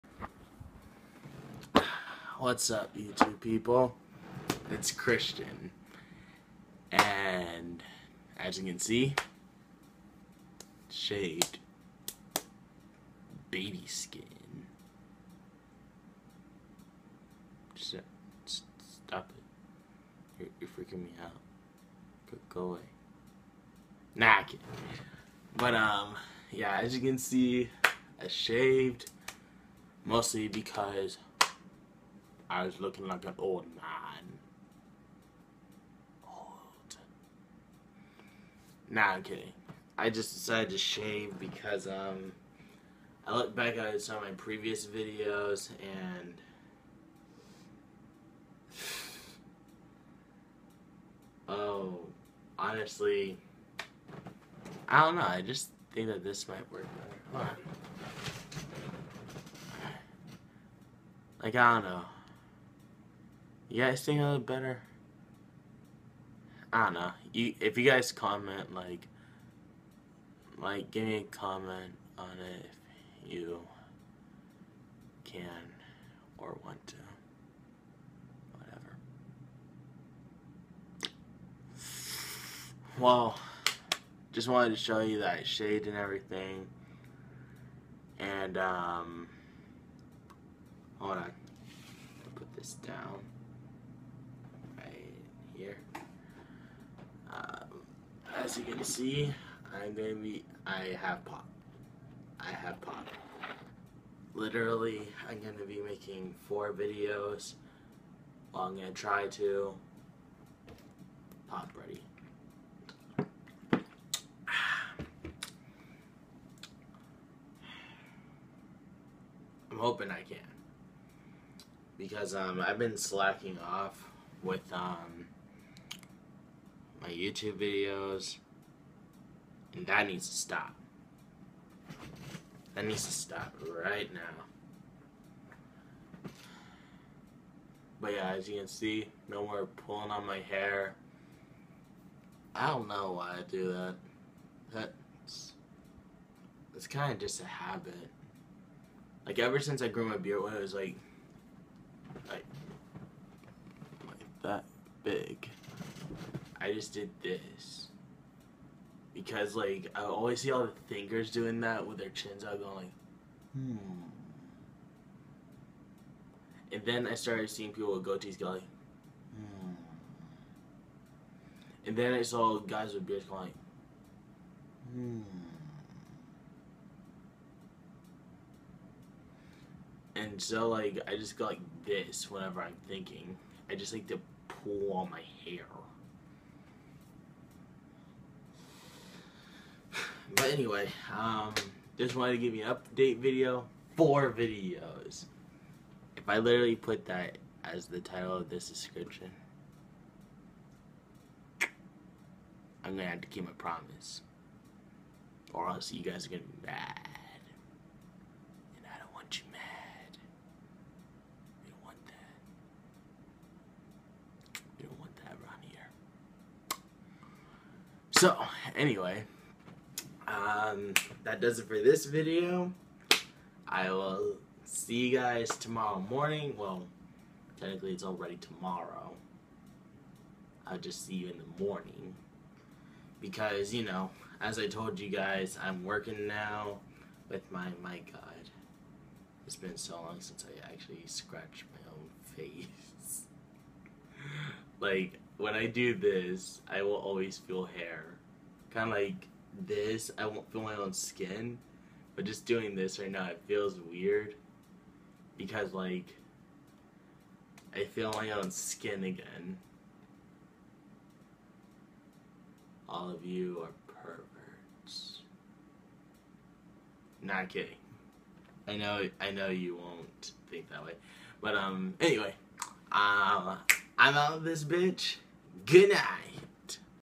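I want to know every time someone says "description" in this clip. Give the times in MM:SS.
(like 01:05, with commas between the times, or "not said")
03:18.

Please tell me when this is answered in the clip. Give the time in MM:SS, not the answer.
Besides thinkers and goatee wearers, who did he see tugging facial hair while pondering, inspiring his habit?
02:52.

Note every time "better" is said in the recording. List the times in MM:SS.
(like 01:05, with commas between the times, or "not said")
00:57, 01:04.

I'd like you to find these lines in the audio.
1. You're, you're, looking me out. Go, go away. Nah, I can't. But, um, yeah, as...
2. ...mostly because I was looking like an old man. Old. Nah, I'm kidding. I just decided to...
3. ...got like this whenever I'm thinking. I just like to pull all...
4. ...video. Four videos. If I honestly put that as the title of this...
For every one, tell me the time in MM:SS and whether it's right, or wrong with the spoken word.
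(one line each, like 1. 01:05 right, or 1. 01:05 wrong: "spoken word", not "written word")
1. 00:20 wrong: "freaking", not "looking"
2. 00:30 right
3. 03:01 right
4. 03:13 wrong: "literally", not "honestly".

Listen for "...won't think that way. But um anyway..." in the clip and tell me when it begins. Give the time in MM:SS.
04:29.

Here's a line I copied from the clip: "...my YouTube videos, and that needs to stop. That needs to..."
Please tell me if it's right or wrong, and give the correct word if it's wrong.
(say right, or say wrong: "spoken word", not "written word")
right.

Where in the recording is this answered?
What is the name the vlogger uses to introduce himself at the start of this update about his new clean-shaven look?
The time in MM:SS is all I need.
00:04.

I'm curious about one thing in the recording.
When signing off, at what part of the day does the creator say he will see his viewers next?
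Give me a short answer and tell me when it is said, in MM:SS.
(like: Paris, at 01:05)
the morning, at 03:51.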